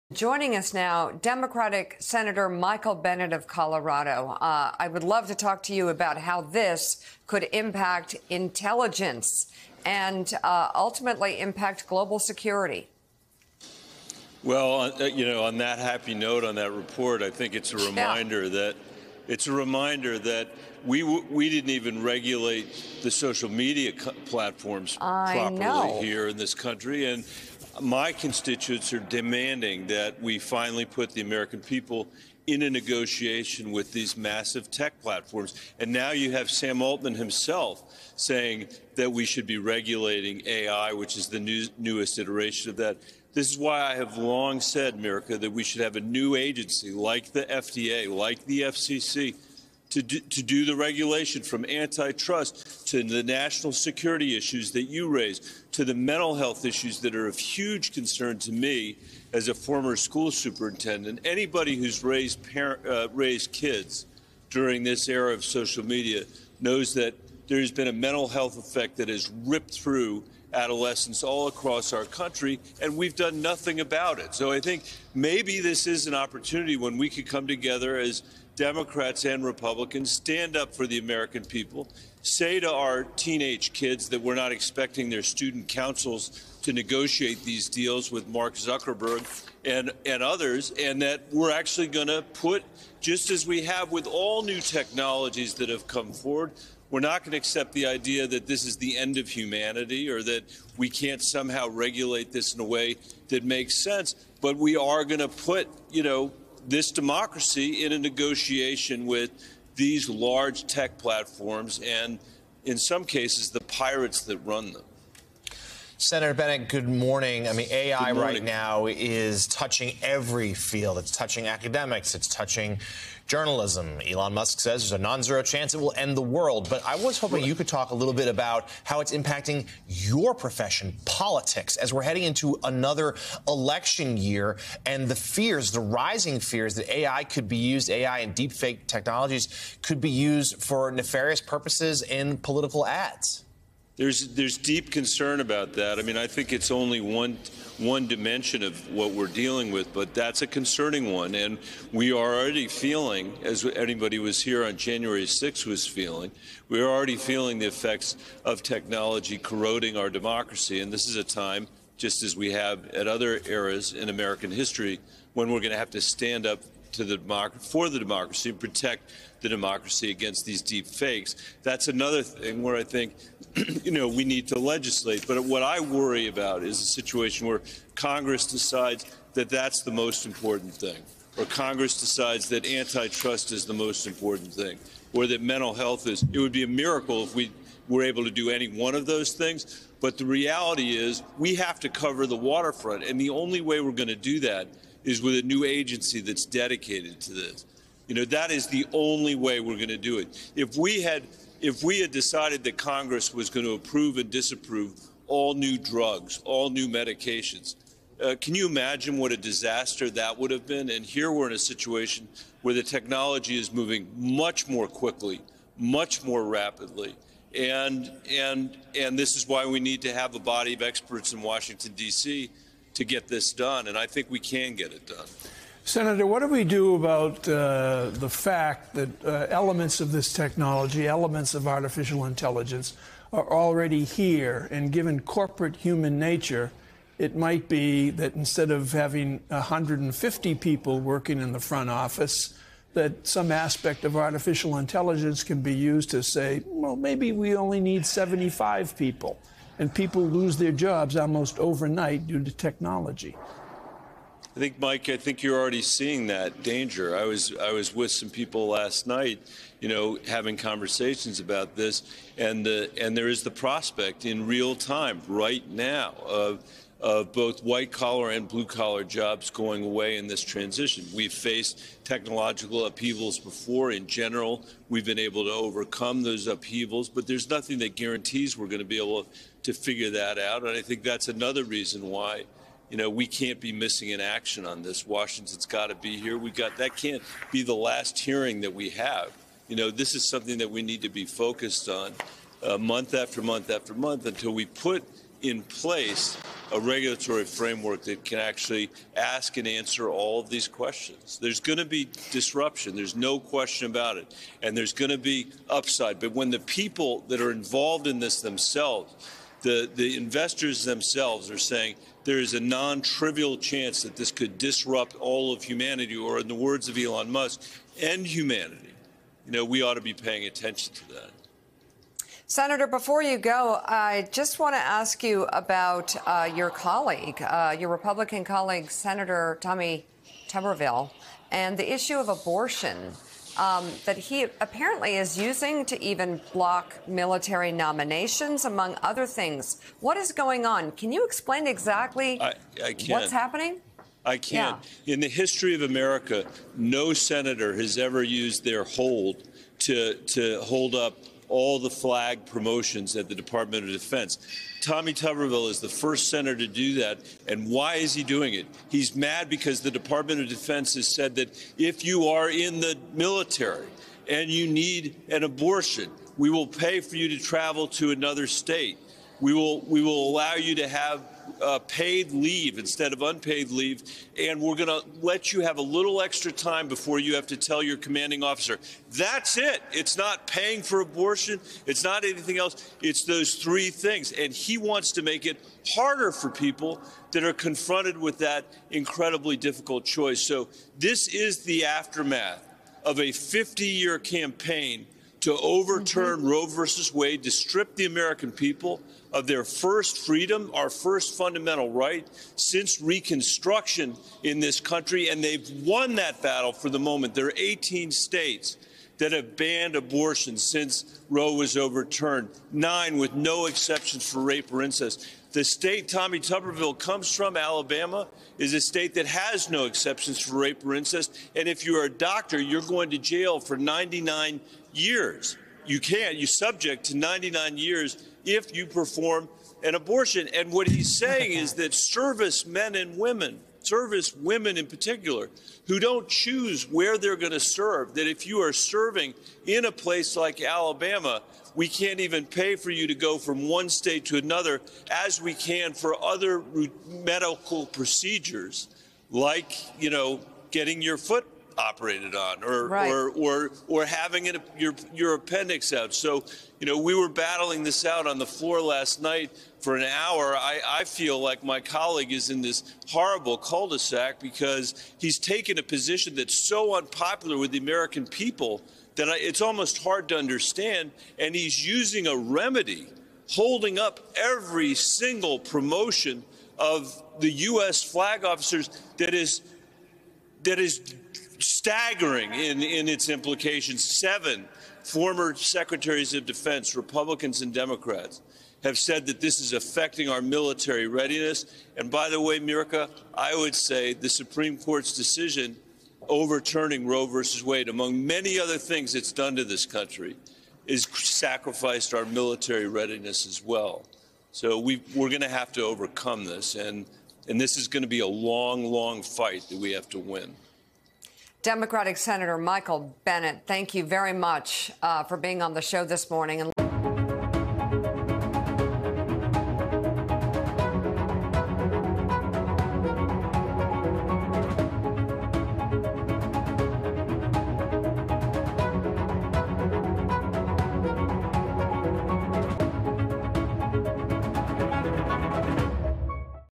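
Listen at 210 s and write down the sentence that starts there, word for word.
And here we're in a situation where the technology is moving much more quickly, much more rapidly.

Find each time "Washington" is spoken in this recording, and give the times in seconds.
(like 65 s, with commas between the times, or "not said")
221 s, 285 s.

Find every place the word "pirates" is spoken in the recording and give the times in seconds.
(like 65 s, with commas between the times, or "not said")
113 s.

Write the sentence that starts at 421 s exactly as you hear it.
And if you're a doctor, you're going to jail for 99 years.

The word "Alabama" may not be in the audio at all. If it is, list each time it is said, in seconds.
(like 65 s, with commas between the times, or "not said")
417 s, 440 s.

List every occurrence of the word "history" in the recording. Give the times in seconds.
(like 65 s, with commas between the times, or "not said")
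164 s, 345 s.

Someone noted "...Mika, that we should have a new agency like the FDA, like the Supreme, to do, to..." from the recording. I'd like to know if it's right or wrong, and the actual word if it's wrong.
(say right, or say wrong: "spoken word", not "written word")
wrong: "FCC", not "Supreme".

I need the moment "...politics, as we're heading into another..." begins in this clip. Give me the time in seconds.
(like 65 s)
131 s.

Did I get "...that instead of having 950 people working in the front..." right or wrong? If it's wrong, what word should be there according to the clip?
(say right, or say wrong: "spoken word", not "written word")
wrong: "150", not "950".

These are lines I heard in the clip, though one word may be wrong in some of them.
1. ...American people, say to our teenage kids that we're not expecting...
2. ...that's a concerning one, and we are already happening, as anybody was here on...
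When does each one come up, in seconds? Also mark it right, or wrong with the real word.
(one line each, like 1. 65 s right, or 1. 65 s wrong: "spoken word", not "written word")
1. 80 s right
2. 150 s wrong: "feeling", not "happening".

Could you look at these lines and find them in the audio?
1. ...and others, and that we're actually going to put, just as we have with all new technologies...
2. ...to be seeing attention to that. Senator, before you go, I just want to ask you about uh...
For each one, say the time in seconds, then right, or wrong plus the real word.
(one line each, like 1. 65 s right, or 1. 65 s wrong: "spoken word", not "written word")
1. 90 s right
2. 319 s wrong: "paying", not "seeing".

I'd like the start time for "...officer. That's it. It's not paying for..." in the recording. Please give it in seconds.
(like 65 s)
378 s.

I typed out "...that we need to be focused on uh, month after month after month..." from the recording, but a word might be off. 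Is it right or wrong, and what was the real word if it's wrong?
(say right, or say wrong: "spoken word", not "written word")
right.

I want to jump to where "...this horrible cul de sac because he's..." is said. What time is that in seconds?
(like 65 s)
462 s.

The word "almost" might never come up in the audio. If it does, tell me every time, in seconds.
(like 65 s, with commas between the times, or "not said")
251 s, 469 s.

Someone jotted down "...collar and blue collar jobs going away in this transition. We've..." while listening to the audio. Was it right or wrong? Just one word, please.
right.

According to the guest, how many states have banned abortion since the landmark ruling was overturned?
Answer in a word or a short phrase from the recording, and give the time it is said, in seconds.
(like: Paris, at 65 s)
18, at 407 s.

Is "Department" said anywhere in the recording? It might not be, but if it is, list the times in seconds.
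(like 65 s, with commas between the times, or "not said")
353 s, 359 s.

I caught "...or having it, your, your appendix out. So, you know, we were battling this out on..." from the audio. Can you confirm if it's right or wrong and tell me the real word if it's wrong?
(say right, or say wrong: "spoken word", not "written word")
right.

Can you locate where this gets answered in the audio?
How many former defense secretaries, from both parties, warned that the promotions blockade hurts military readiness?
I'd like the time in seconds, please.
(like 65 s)
484 s.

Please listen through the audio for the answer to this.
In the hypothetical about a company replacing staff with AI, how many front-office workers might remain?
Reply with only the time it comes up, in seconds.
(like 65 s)
248 s.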